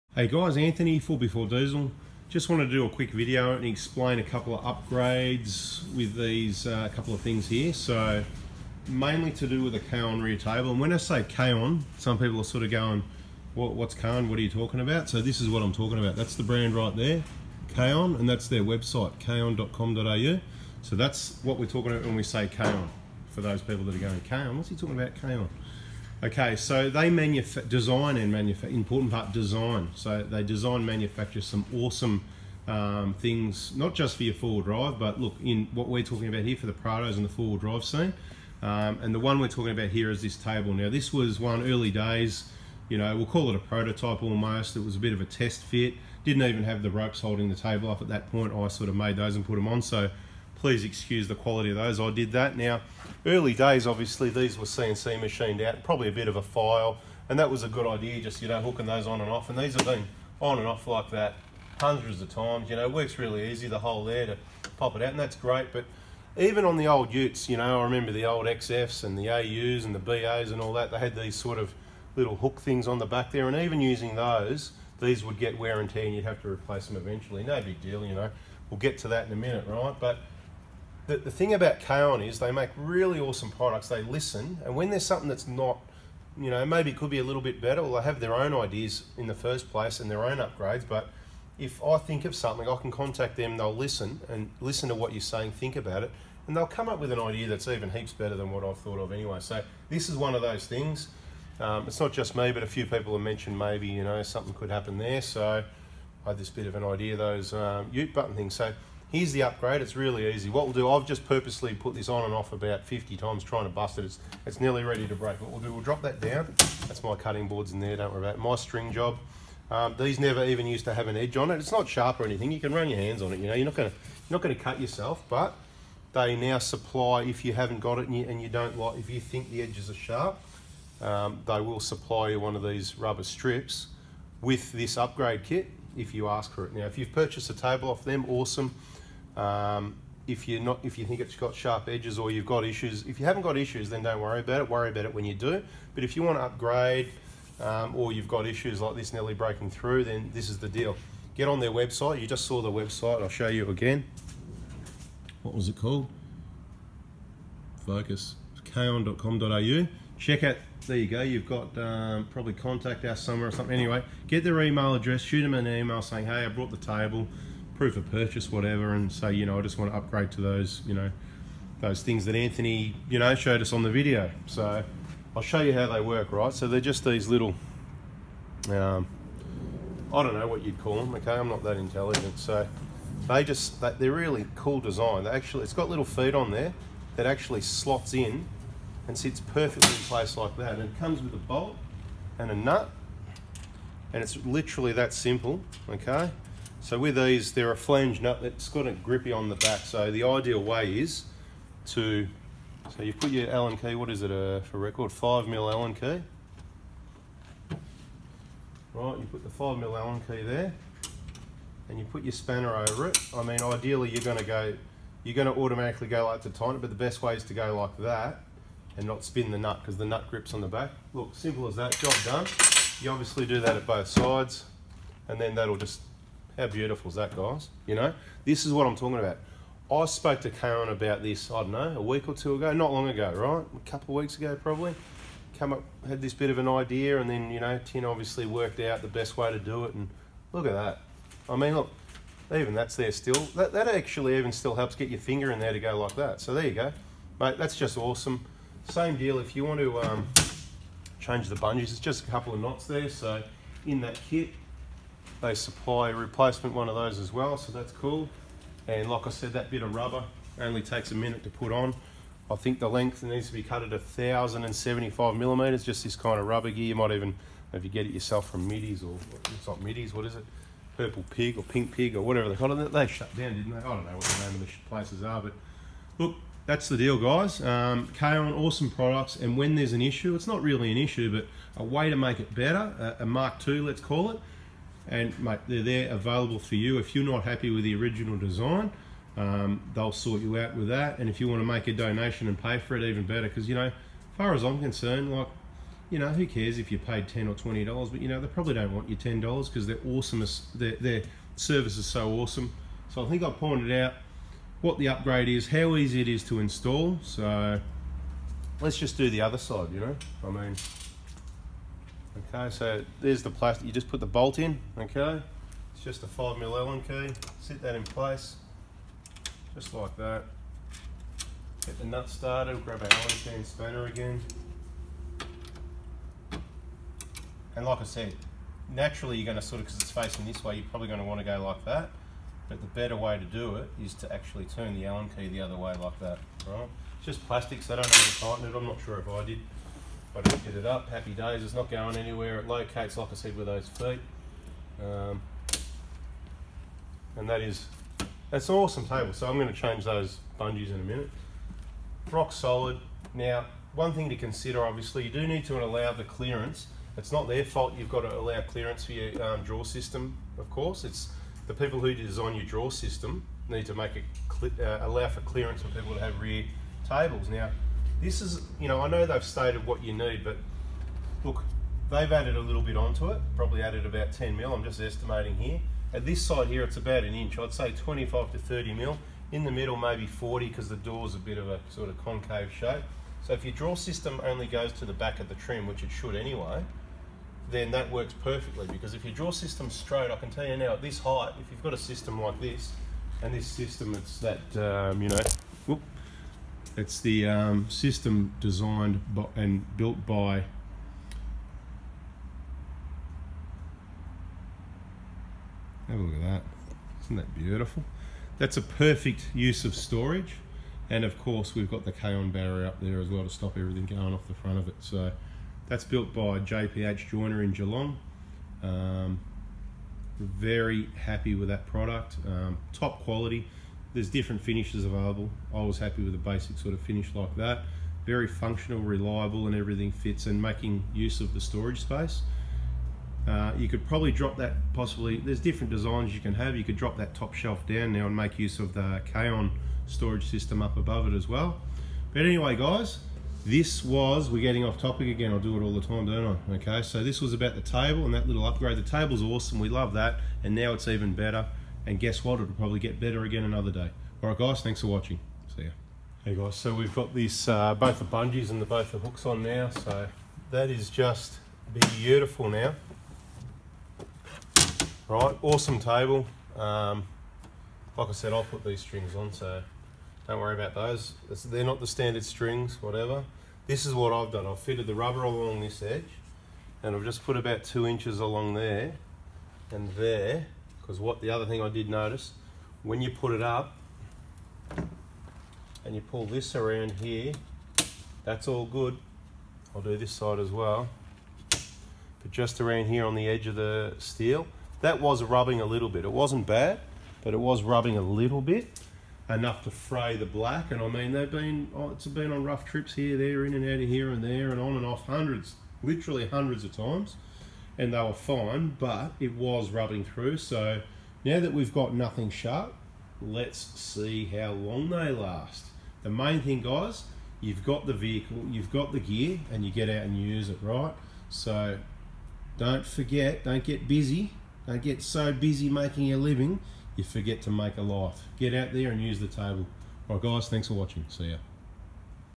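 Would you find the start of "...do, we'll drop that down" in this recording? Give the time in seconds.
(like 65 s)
115 s.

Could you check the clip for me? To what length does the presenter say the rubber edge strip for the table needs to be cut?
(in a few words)
1,075 millimeters.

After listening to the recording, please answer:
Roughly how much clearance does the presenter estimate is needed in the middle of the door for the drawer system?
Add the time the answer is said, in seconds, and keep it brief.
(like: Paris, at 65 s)
40 mm, at 379 s.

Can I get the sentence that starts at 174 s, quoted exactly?
So I'll show you how they work, right?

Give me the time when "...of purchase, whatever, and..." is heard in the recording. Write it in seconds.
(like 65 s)
167 s.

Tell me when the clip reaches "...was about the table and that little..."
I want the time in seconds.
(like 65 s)
447 s.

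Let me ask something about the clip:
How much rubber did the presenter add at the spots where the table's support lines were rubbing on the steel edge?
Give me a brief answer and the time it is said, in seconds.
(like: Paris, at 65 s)
2 inches, at 477 s.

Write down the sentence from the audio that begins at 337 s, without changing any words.
It's just plastic, so I don't know how to tighten it.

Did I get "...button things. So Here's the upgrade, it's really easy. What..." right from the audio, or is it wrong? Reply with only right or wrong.
right.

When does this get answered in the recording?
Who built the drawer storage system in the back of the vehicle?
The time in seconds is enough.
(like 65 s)
416 s.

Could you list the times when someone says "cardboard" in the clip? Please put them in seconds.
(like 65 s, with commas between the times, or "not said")
not said.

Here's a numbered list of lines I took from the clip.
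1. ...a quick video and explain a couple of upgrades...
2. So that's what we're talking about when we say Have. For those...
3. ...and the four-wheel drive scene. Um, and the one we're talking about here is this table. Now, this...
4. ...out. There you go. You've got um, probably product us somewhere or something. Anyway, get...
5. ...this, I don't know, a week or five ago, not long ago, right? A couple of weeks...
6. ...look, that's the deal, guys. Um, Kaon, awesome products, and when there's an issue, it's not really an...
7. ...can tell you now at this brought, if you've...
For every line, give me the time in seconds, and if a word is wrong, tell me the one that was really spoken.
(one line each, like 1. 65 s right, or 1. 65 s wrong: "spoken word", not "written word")
1. 2 s right
2. 20 s wrong: "Kaon", not "Have"
3. 37 s right
4. 160 s wrong: "contact", not "product"
5. 231 s wrong: "two", not "five"
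6. 276 s right
7. 390 s wrong: "height", not "brought".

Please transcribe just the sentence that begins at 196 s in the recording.
So with these, they're a flange nut that's got a grippy on the back.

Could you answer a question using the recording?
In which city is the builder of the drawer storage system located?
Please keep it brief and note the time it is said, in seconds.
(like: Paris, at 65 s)
Geelong, at 417 s.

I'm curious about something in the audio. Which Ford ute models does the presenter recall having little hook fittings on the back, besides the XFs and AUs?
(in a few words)
BAs.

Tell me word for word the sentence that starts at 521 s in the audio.
So don't forget, don't get busy.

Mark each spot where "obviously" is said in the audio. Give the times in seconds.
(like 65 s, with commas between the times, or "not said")
53 s, 223 s, 238 s, 354 s.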